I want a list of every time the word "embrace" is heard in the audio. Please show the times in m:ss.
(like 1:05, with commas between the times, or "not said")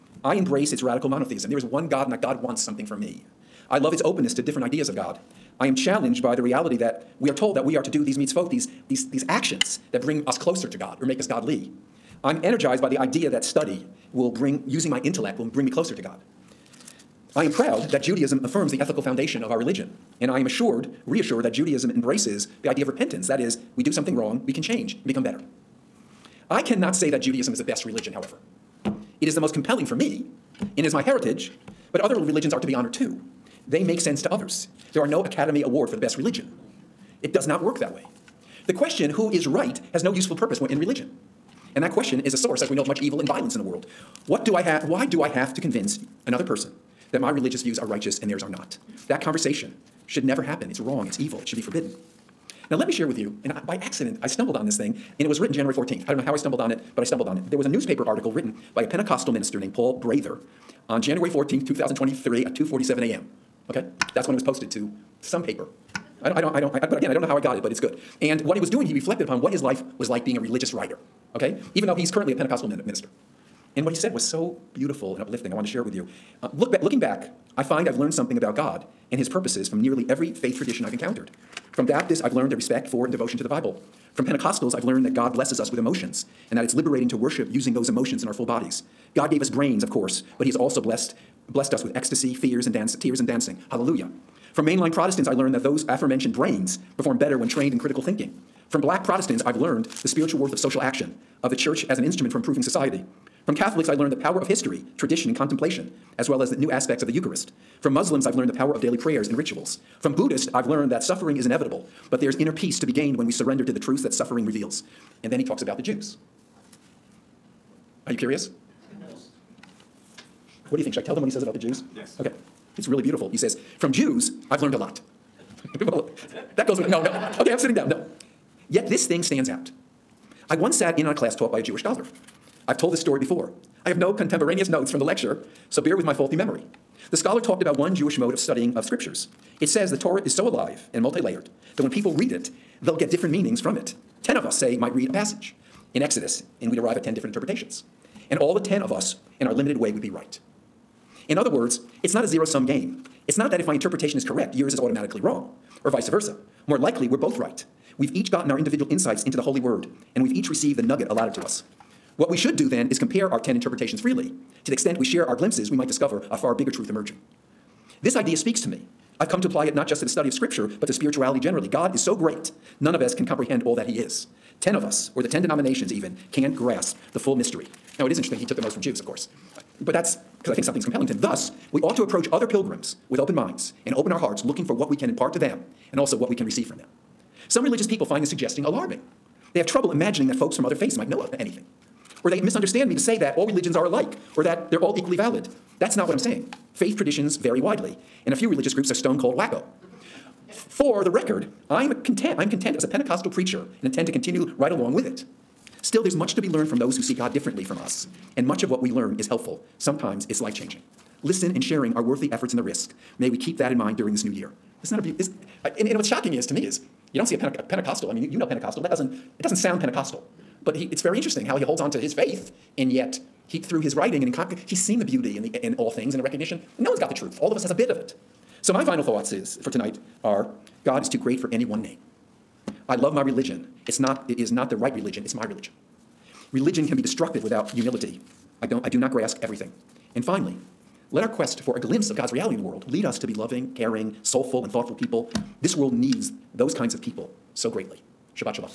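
0:00, 0:21.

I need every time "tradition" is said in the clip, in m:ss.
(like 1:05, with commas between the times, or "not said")
1:20, 1:44, 3:16.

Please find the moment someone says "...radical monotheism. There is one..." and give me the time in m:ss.
0:00.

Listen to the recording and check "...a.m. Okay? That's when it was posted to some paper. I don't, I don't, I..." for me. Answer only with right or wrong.
right.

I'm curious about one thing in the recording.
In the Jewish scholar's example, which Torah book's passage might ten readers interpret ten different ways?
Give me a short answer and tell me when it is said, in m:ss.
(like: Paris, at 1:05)
Exodus, at 2:26.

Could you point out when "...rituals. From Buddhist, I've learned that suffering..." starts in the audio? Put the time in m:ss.
1:49.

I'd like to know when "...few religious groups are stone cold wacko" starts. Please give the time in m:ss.
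3:18.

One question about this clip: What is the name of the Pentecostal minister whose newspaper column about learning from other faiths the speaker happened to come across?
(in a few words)
Paul Prather.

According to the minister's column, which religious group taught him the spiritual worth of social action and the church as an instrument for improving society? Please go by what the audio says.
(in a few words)
Black Protestants.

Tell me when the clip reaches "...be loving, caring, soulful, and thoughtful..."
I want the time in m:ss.
4:03.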